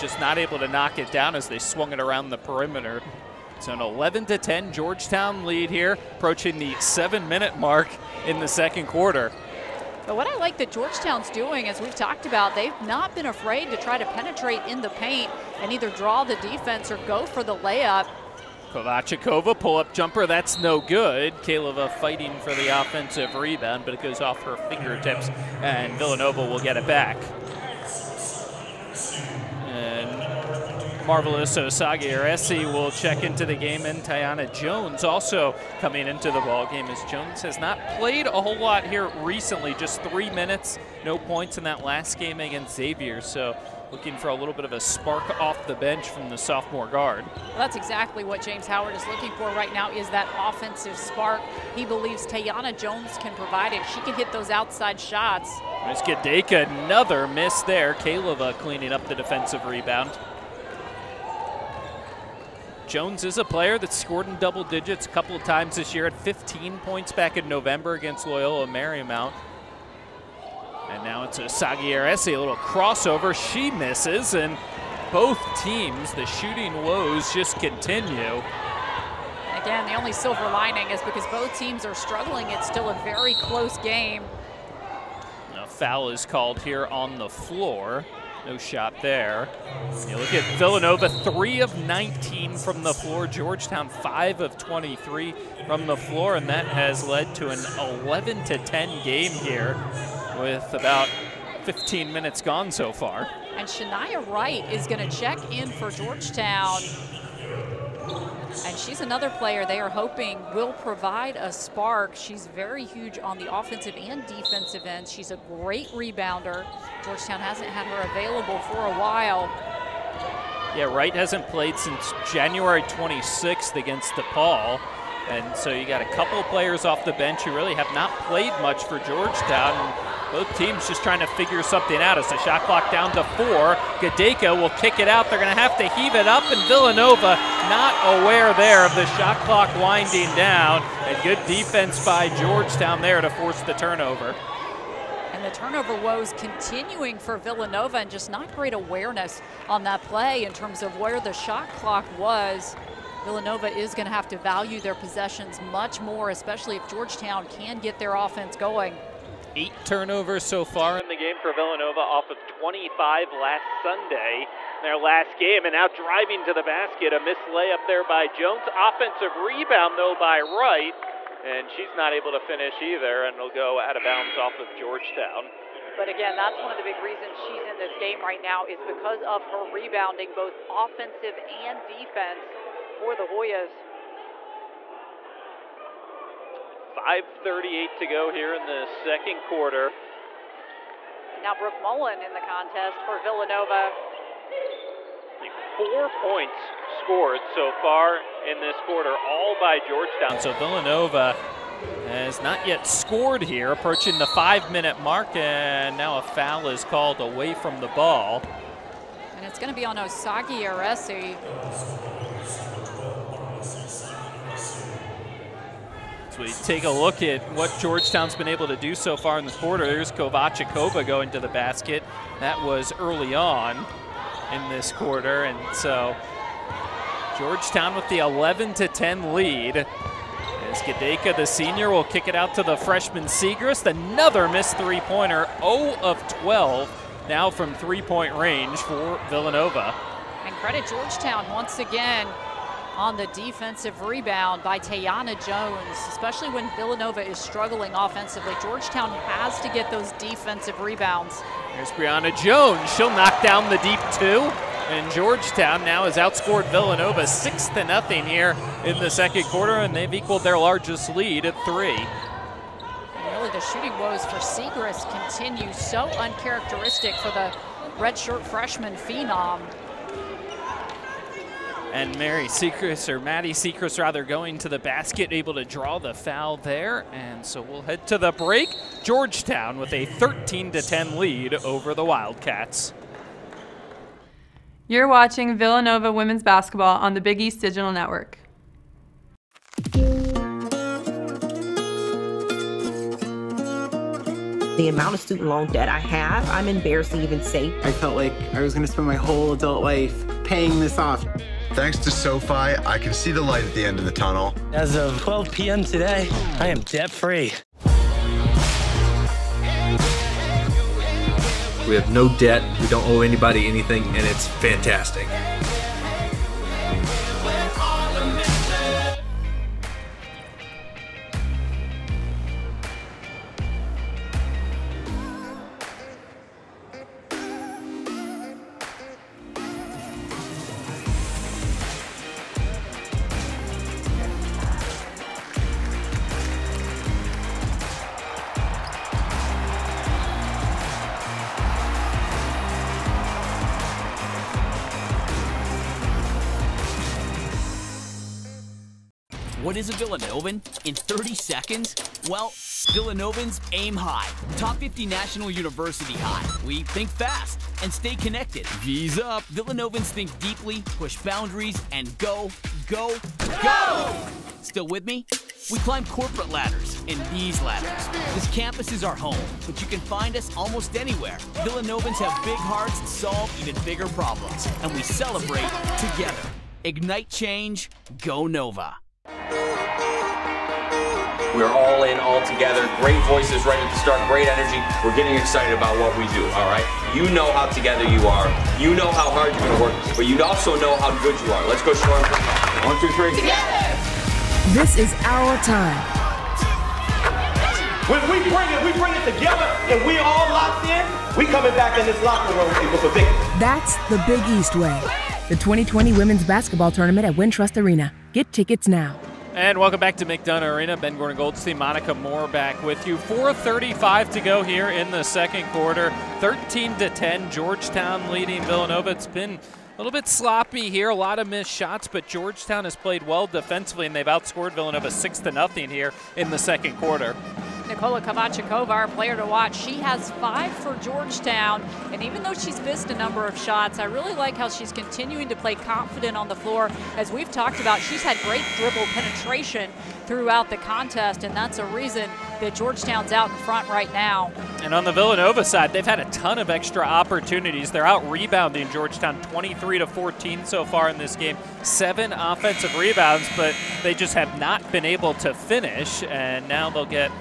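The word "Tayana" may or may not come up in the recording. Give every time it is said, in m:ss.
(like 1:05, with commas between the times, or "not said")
0:52, 4:04.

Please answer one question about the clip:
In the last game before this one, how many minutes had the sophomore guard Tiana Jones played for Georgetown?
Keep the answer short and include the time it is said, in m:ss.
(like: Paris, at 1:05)
3, at 0:39.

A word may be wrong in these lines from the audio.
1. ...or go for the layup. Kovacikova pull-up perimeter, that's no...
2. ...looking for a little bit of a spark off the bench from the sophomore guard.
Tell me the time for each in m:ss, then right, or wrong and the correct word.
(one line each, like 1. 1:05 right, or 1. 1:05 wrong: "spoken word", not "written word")
1. 0:16 wrong: "jumper", not "perimeter"
2. 0:43 right.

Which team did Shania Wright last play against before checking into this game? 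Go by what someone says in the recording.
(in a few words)
DePaul.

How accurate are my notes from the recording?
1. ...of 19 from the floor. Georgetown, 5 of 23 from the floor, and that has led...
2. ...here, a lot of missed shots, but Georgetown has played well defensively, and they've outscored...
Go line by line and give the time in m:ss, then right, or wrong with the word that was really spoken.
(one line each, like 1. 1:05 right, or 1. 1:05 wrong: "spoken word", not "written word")
1. 1:31 right
2. 7:00 right.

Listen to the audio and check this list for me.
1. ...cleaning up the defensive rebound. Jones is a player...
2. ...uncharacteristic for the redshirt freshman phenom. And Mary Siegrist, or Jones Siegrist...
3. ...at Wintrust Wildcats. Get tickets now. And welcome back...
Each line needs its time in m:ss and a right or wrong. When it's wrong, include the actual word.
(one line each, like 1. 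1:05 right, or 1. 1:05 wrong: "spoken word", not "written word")
1. 0:58 right
2. 4:26 wrong: "Maddy", not "Jones"
3. 6:47 wrong: "Arena", not "Wildcats".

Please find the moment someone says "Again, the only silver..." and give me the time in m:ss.
1:19.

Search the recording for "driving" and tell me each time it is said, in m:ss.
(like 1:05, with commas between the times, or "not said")
2:45.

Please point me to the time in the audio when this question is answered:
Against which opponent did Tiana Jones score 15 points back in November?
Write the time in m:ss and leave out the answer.
1:08.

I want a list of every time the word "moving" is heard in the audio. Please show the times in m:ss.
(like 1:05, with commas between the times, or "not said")
not said.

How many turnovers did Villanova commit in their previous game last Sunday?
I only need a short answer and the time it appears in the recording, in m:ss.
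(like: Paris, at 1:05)
25, at 2:42.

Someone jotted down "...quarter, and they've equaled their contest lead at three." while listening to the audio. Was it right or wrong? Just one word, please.
wrong.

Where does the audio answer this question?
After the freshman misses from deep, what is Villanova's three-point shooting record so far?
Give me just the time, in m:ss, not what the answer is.
3:55.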